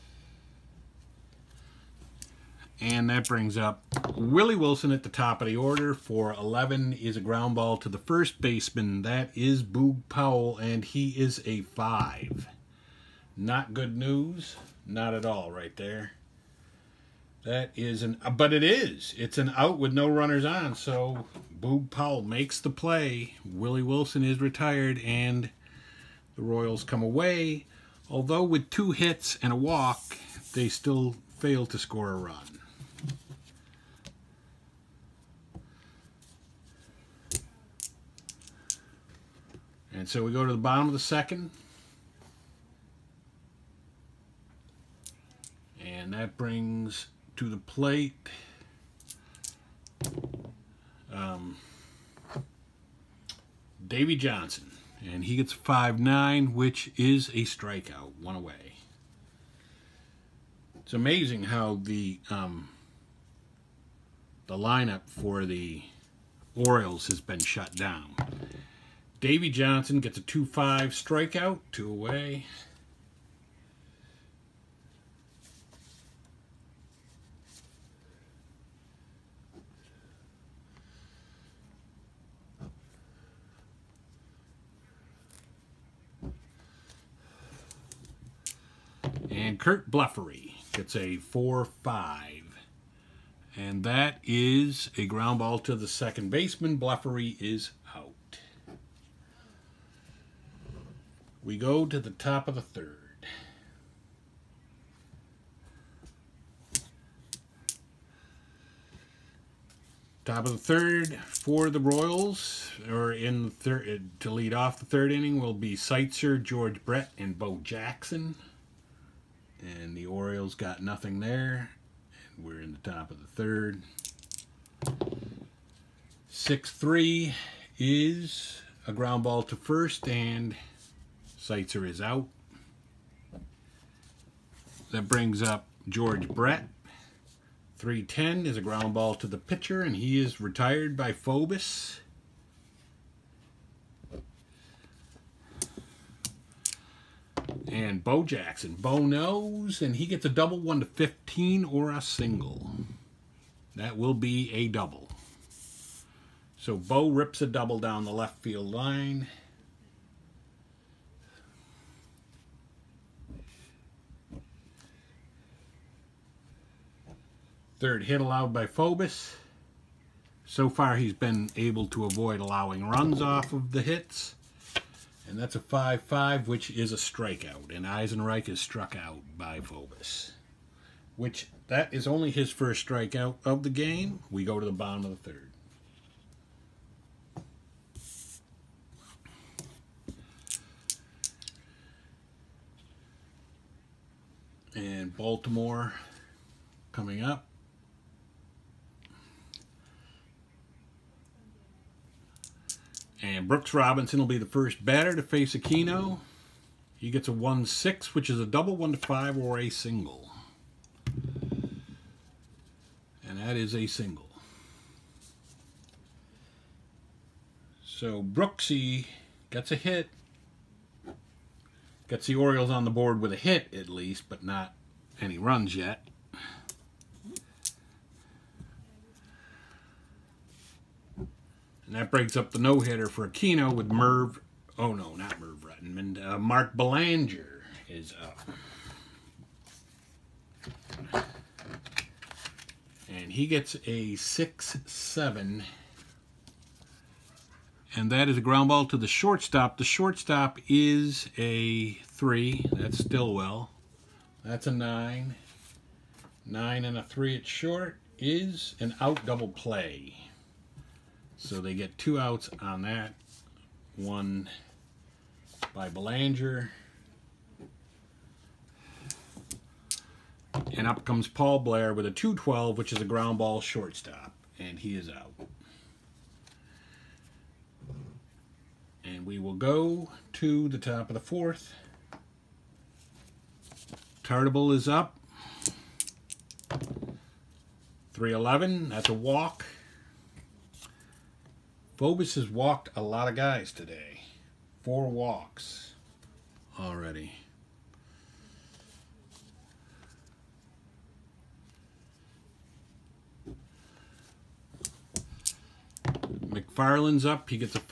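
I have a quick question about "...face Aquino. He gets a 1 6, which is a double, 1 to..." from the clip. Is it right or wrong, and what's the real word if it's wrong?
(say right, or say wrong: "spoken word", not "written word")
right.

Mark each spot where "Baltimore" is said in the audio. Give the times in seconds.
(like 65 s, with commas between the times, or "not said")
195 s.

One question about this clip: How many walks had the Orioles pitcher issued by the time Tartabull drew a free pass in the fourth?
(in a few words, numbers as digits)
4.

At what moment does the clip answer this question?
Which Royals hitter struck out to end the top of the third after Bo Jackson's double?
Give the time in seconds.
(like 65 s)
177 s.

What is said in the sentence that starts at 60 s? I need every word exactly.
It's amazing how the um, the lineup for the Orioles has been shut down.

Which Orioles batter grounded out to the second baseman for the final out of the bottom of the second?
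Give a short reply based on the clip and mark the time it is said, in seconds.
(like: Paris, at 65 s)
Curt Blefary, at 89 s.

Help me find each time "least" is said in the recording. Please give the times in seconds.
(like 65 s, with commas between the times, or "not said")
223 s.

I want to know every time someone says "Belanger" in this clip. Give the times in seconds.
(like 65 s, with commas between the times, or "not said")
236 s, 265 s.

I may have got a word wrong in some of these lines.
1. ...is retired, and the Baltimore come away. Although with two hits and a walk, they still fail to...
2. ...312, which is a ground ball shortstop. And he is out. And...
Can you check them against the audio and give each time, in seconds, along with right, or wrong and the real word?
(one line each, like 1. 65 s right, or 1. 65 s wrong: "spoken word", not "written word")
1. 24 s wrong: "Royals", not "Baltimore"
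2. 272 s wrong: "212", not "312".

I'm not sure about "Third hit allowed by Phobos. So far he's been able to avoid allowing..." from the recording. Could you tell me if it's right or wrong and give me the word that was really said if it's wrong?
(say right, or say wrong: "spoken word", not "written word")
right.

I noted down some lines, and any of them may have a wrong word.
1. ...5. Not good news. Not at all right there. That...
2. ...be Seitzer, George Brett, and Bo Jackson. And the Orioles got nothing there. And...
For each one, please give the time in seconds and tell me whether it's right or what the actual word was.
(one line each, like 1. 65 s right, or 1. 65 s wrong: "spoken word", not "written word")
1. 11 s right
2. 115 s right.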